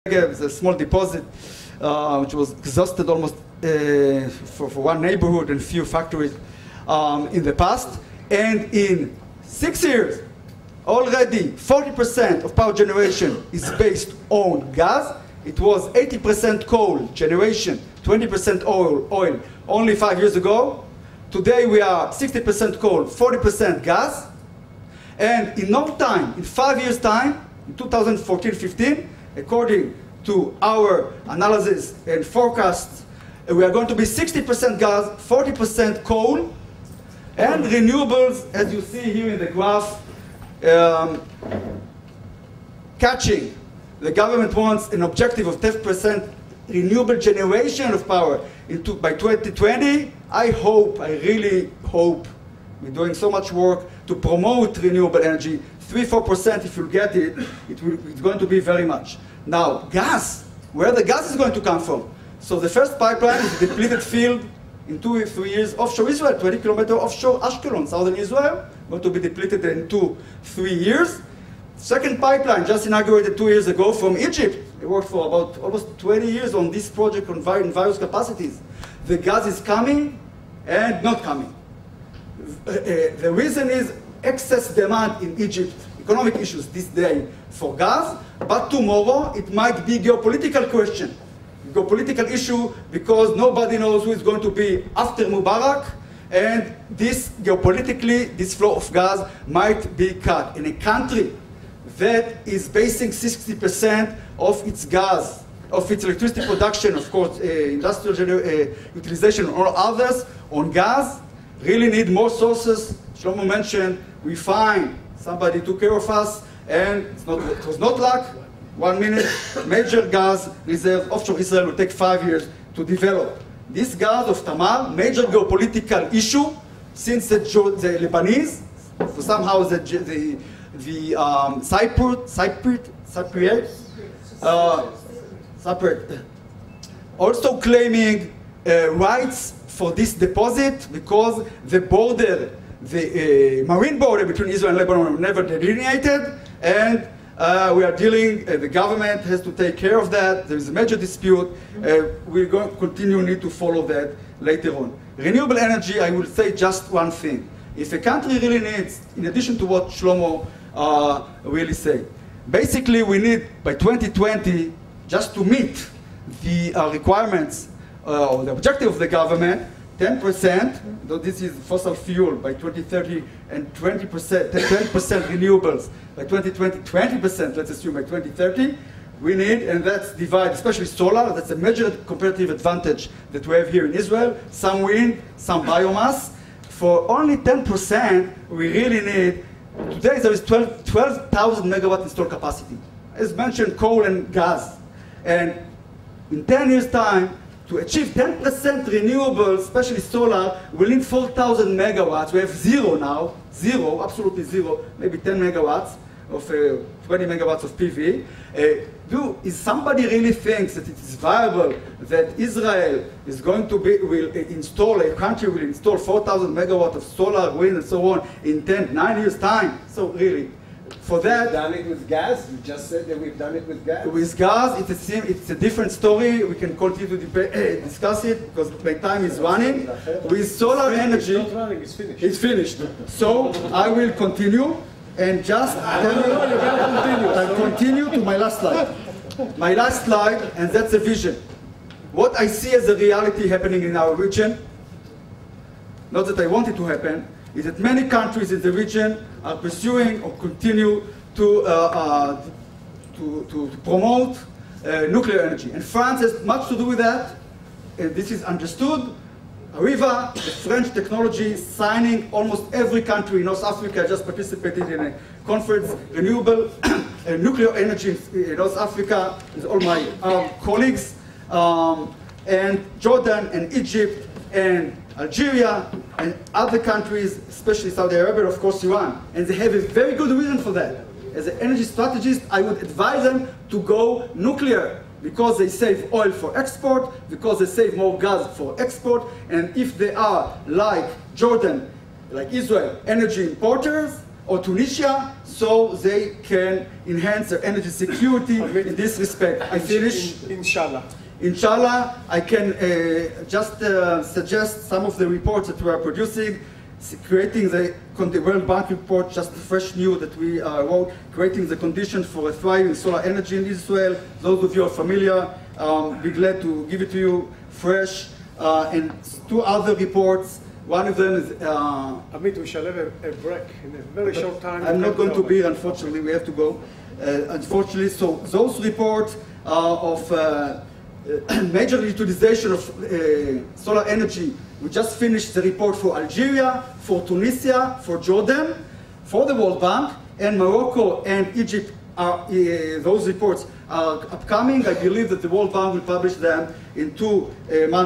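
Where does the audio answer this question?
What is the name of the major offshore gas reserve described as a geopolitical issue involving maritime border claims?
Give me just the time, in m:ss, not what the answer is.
2:04.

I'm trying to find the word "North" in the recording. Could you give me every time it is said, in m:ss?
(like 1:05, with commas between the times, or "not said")
4:23, 4:28.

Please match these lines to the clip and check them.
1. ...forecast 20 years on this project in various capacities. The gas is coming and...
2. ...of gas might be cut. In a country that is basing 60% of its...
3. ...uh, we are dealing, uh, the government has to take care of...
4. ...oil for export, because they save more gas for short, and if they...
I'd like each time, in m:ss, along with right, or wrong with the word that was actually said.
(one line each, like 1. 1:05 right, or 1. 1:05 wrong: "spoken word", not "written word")
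1. 1:15 wrong: "almost", not "forecast"
2. 1:38 right
3. 2:27 right
4. 4:46 wrong: "export", not "short".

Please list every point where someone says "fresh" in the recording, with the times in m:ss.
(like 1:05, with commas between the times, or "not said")
5:09, 5:17.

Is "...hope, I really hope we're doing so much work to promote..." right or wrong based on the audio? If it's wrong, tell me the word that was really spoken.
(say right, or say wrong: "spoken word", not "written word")
right.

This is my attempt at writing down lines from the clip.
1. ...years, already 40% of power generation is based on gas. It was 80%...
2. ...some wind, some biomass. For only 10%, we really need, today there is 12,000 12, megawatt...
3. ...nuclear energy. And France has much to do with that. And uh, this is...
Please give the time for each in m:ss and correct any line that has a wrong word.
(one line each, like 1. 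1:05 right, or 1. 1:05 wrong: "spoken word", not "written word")
1. 0:09 right
2. 3:04 right
3. 4:15 right.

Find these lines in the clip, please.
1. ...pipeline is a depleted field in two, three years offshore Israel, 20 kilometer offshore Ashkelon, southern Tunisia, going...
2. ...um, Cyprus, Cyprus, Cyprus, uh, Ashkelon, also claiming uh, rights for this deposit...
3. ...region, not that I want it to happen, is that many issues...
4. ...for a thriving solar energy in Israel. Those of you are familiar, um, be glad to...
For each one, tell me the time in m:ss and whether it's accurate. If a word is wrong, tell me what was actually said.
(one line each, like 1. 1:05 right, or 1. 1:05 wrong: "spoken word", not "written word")
1. 1:02 wrong: "Israel", not "Tunisia"
2. 2:11 wrong: "Cyprus", not "Ashkelon"
3. 4:04 wrong: "countries", not "issues"
4. 5:12 right.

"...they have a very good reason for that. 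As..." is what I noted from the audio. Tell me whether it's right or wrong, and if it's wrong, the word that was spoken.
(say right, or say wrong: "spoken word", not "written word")
right.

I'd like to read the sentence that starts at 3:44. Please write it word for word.
With gas, it's a it's a different story.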